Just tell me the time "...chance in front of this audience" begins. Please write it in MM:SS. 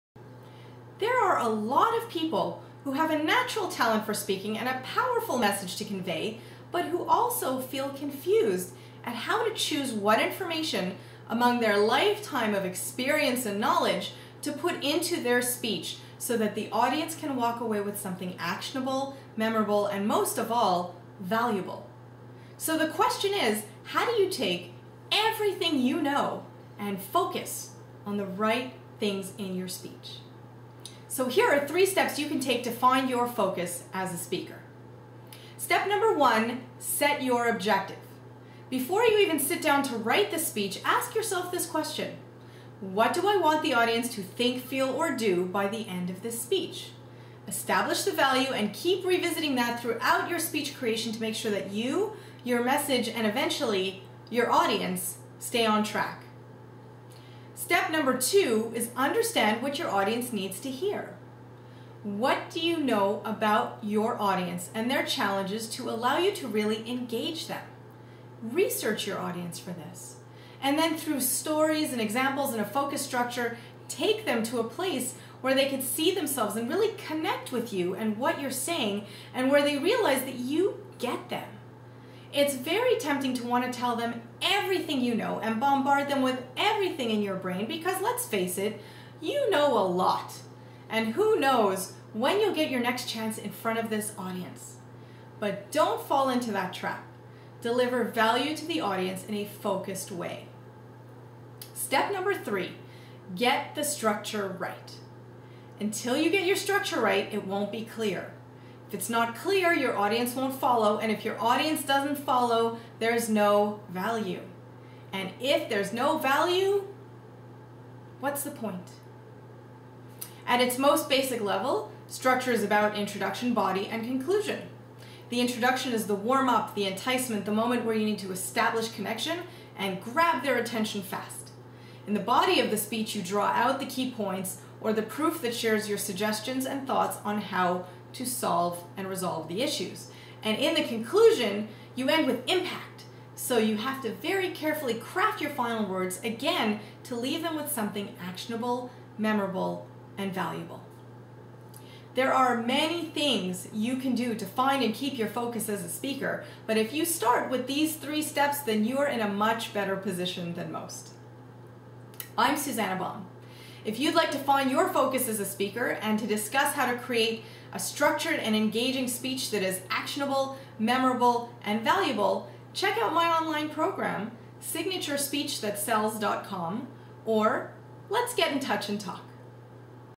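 01:33.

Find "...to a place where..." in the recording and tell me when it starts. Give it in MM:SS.
01:14.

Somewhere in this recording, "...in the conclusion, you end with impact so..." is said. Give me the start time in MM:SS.
02:20.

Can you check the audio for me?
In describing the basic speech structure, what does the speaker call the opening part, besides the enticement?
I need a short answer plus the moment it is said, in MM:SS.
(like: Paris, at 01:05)
The warm up, at 02:06.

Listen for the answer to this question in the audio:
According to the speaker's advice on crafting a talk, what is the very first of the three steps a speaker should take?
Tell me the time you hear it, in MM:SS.
00:36.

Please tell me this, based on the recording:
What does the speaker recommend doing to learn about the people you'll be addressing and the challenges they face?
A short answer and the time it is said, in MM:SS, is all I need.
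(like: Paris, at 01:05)
Research your audience, at 01:08.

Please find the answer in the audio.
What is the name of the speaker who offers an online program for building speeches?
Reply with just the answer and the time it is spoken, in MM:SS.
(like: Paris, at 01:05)
Suzannah Baum, at 02:42.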